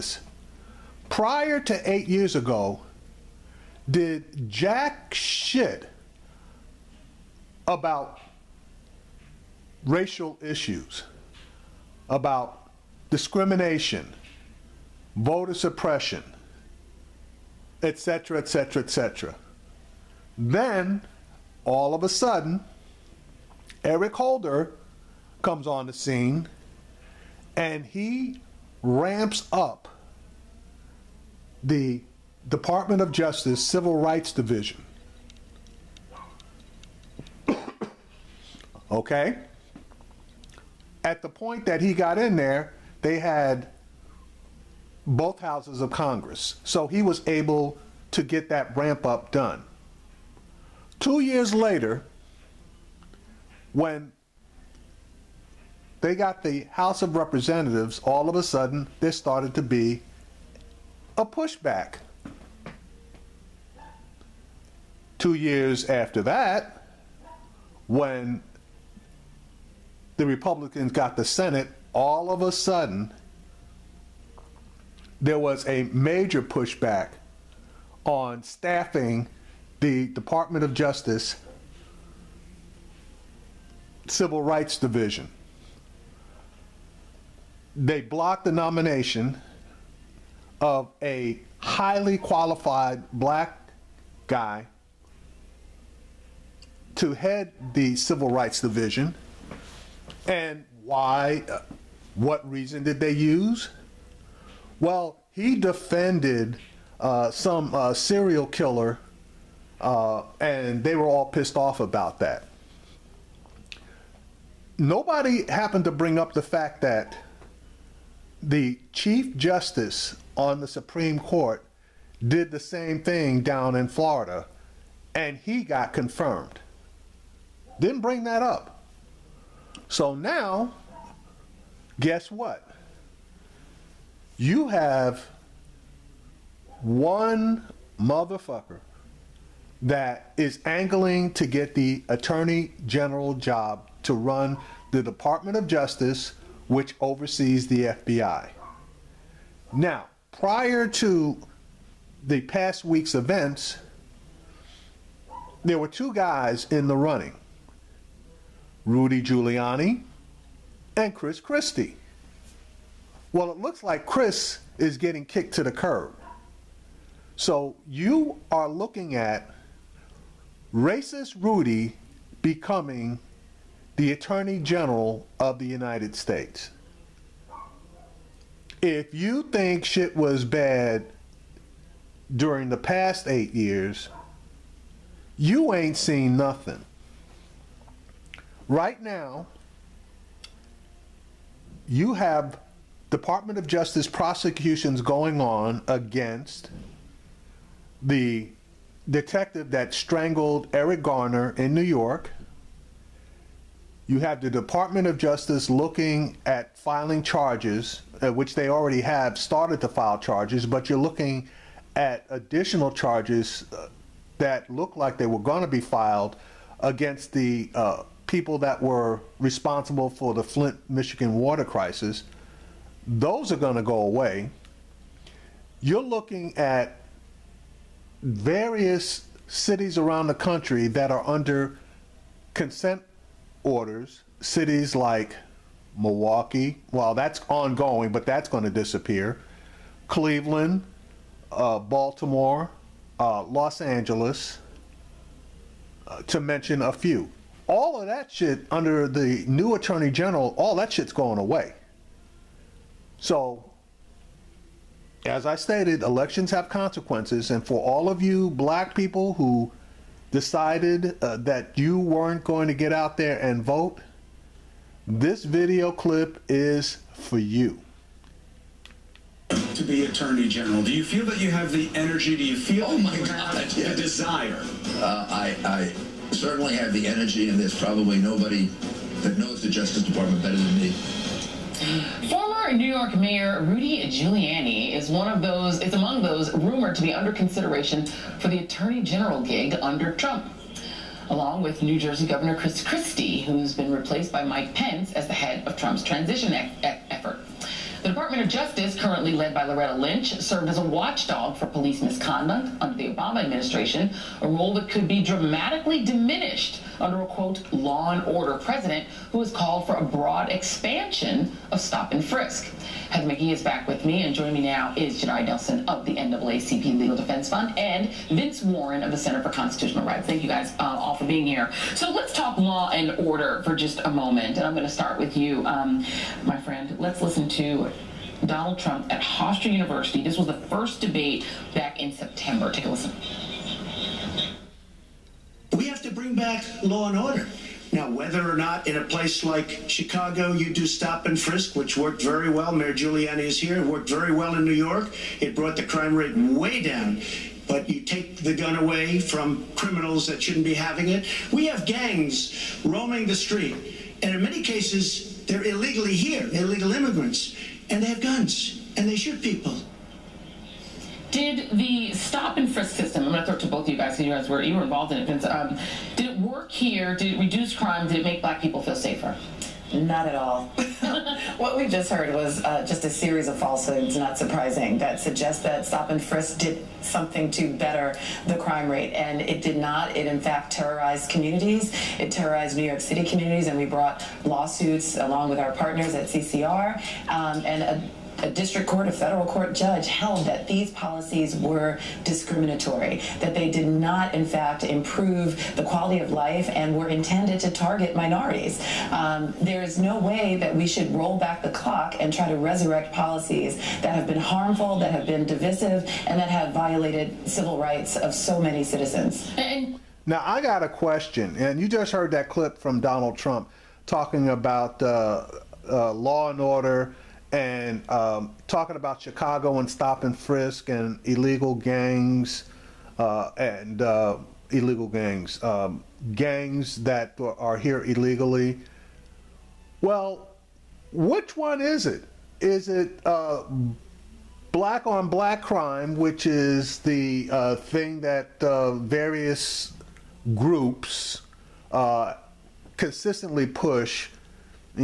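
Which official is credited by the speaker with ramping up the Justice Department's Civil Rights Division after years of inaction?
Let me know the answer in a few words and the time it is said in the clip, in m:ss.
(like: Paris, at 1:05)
Eric Holder, at 0:23.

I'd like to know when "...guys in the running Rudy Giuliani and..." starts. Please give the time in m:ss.
2:36.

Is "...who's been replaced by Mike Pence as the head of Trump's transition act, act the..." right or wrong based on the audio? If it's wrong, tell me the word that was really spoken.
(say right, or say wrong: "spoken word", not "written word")
right.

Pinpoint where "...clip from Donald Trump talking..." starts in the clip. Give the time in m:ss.
6:52.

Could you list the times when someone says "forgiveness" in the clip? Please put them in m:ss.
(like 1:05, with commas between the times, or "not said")
not said.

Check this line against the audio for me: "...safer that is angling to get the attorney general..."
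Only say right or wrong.
wrong.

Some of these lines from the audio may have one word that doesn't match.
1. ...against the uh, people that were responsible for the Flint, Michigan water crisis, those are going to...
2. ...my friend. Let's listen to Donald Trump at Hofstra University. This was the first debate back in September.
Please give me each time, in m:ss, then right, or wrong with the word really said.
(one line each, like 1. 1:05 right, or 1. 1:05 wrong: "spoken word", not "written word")
1. 3:36 right
2. 5:26 right.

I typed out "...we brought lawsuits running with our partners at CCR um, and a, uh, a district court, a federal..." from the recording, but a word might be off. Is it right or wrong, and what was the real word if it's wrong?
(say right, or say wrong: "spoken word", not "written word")
wrong: "along", not "running".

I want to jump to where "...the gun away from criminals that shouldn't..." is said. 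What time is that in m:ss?
5:48.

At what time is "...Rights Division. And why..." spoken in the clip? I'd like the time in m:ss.
1:38.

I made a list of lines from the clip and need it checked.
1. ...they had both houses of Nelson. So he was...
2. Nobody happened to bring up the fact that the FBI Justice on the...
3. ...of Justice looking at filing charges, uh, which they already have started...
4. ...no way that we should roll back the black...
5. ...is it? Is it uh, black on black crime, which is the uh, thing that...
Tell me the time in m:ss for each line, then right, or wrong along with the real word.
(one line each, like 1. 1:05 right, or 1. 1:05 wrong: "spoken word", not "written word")
1. 0:43 wrong: "Congress", not "Nelson"
2. 1:54 wrong: "Chief", not "FBI"
3. 3:25 right
4. 6:39 wrong: "clock", not "black"
5. 7:11 right.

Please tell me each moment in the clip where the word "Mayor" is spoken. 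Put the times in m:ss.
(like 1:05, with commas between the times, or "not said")
4:43, 5:42.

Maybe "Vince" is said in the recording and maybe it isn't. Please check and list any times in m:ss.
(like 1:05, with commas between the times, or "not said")
5:18, 6:05.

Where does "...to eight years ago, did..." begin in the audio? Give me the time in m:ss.
0:01.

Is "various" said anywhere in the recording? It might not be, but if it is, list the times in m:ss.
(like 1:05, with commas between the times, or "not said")
3:48, 7:18.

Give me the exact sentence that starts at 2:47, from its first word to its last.
So you are looking at racist Rudy becoming the Attorney General of the United States.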